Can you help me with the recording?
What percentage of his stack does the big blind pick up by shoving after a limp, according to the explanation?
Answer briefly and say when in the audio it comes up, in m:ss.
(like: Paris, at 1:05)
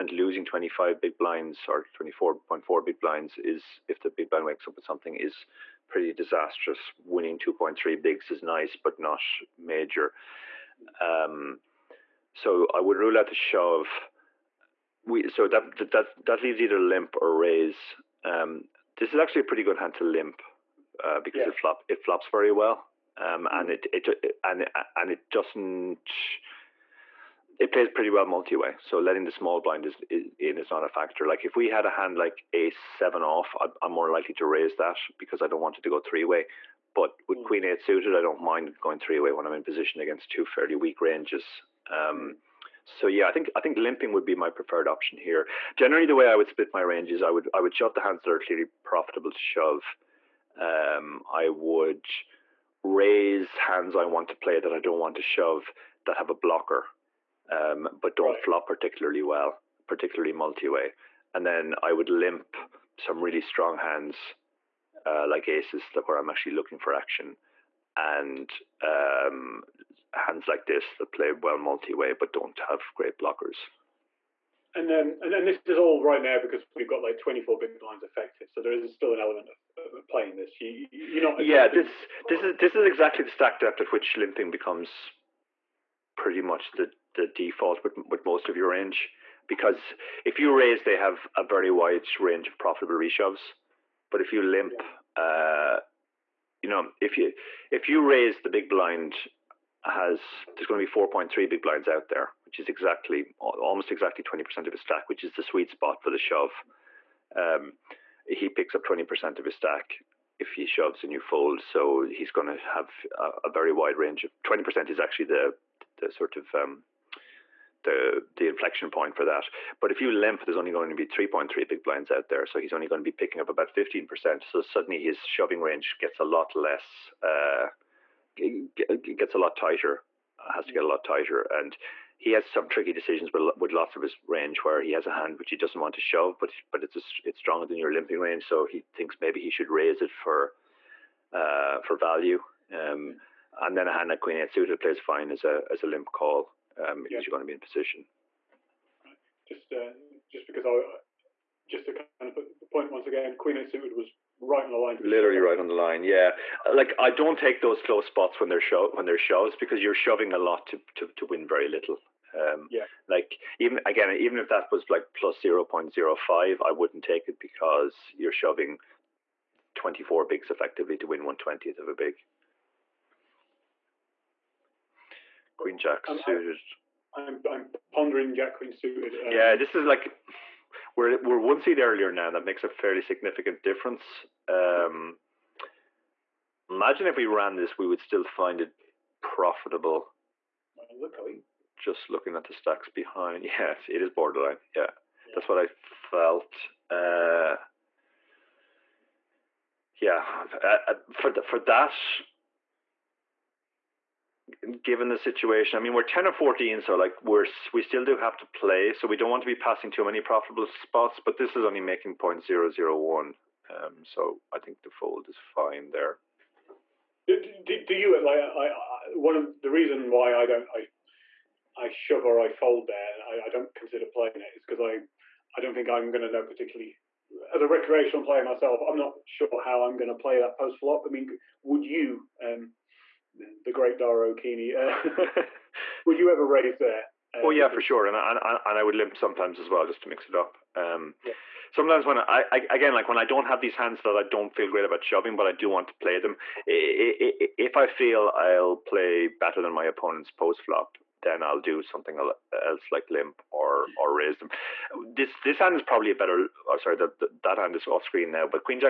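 15%, at 2:03.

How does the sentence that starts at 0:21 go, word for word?
it flop it flops very well, um, and hmm.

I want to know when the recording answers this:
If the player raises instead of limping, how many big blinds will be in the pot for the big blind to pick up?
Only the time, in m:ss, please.
1:41.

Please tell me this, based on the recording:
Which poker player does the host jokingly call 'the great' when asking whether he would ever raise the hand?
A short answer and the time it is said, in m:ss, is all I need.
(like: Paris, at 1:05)
Dara O'Kearney, at 3:53.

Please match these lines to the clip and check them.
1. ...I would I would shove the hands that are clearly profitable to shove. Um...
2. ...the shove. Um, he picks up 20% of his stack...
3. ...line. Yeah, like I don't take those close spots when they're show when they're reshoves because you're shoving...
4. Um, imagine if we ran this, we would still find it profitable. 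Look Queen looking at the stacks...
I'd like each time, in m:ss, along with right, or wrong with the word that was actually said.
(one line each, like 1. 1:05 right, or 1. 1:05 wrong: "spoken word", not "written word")
1. 0:47 right
2. 1:46 right
3. 2:35 wrong: "shoves", not "reshoves"
4. 3:04 wrong: "Just", not "Queen".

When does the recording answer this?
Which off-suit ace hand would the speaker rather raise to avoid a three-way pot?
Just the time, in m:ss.
0:32.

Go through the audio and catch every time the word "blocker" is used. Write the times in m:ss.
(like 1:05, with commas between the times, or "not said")
0:56, 1:13.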